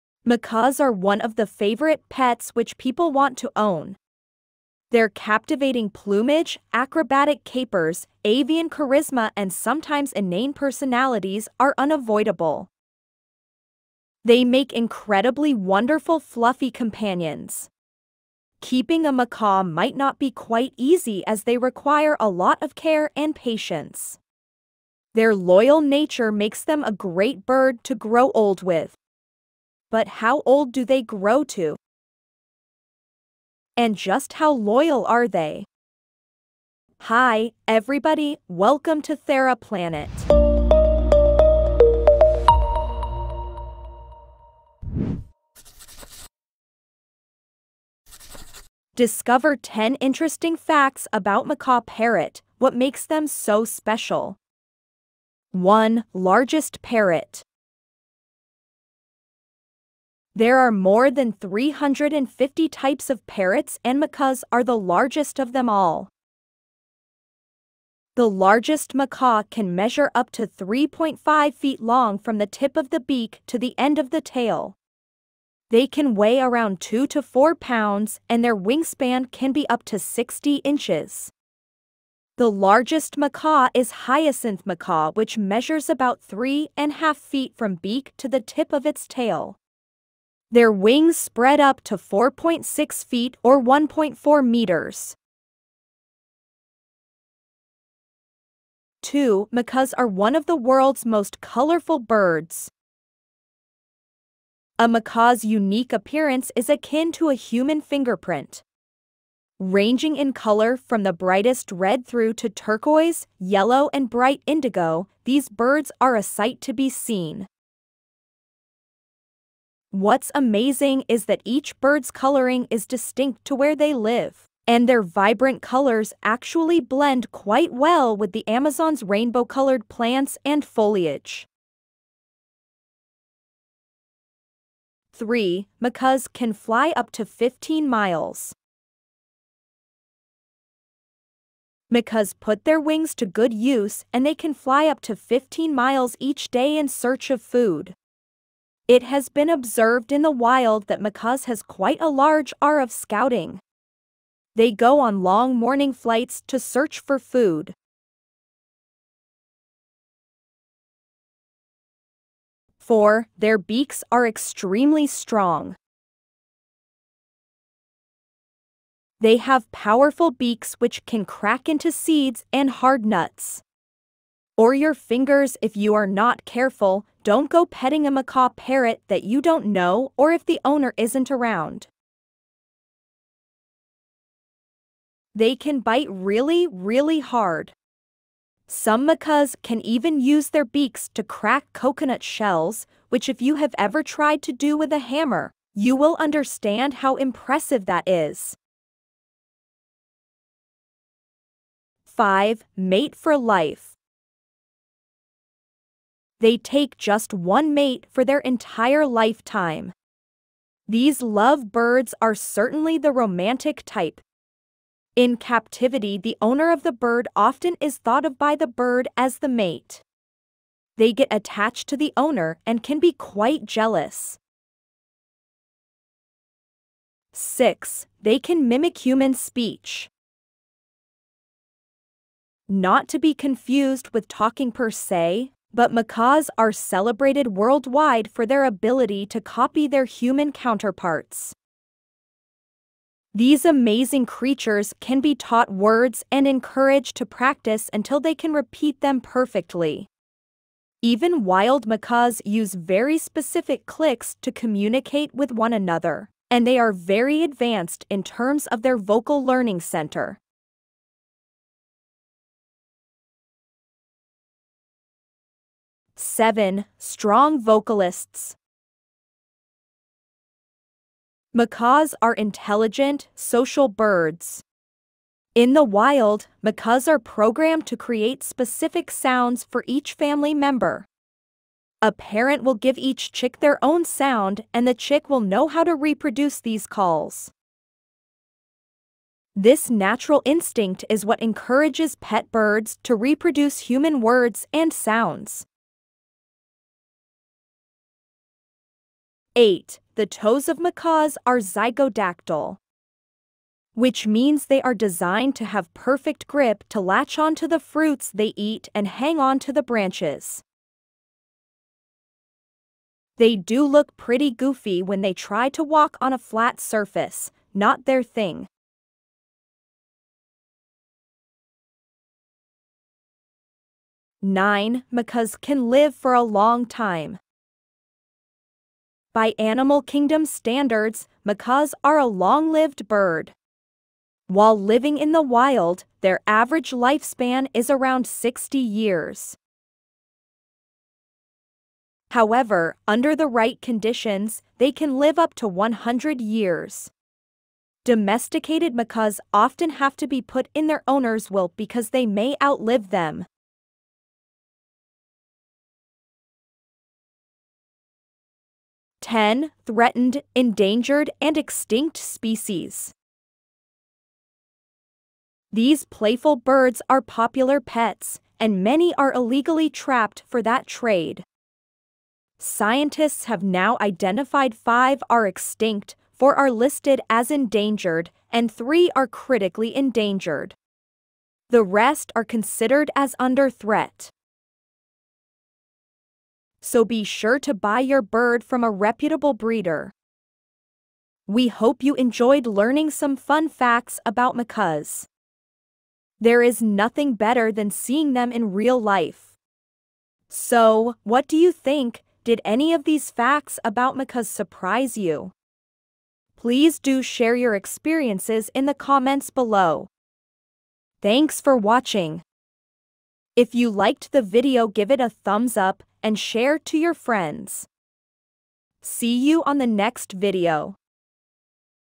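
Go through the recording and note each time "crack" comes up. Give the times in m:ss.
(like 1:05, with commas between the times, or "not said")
2:51, 3:11.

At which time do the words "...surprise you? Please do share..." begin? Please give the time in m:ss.
6:44.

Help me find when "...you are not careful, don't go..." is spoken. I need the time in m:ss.
2:55.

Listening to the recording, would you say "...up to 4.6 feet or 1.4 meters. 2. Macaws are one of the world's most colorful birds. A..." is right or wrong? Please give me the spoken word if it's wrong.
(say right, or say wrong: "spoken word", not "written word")
right.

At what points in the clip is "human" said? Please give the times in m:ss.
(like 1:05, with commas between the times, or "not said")
1:47, 3:49, 4:00, 4:53.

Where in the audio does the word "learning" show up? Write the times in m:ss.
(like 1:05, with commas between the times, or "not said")
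4:19, 6:32.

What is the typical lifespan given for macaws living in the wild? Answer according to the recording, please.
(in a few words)
60 years.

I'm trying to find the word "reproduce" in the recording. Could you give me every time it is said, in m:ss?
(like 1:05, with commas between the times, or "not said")
4:45, 4:53.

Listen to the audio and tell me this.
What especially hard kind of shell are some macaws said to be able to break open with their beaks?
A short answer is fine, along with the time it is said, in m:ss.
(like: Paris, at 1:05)
coconut shells, at 3:11.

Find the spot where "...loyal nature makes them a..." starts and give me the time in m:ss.
0:25.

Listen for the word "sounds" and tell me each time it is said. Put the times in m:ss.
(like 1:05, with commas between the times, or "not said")
4:39, 4:44, 4:54.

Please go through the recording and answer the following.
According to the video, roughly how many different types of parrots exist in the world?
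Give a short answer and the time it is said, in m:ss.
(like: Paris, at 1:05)
more than 350, at 1:00.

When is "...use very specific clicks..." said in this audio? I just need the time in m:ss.
4:12.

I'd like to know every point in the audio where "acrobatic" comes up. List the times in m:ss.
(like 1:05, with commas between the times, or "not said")
0:06.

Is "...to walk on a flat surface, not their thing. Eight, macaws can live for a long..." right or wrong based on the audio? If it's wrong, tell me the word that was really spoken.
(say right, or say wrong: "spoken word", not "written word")
wrong: "Nine", not "Eight".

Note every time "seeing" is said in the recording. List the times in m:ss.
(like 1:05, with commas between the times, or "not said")
6:37.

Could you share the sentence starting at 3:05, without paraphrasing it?
They can bite really, really hard.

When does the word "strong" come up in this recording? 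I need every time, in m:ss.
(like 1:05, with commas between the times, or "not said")
2:45, 4:26.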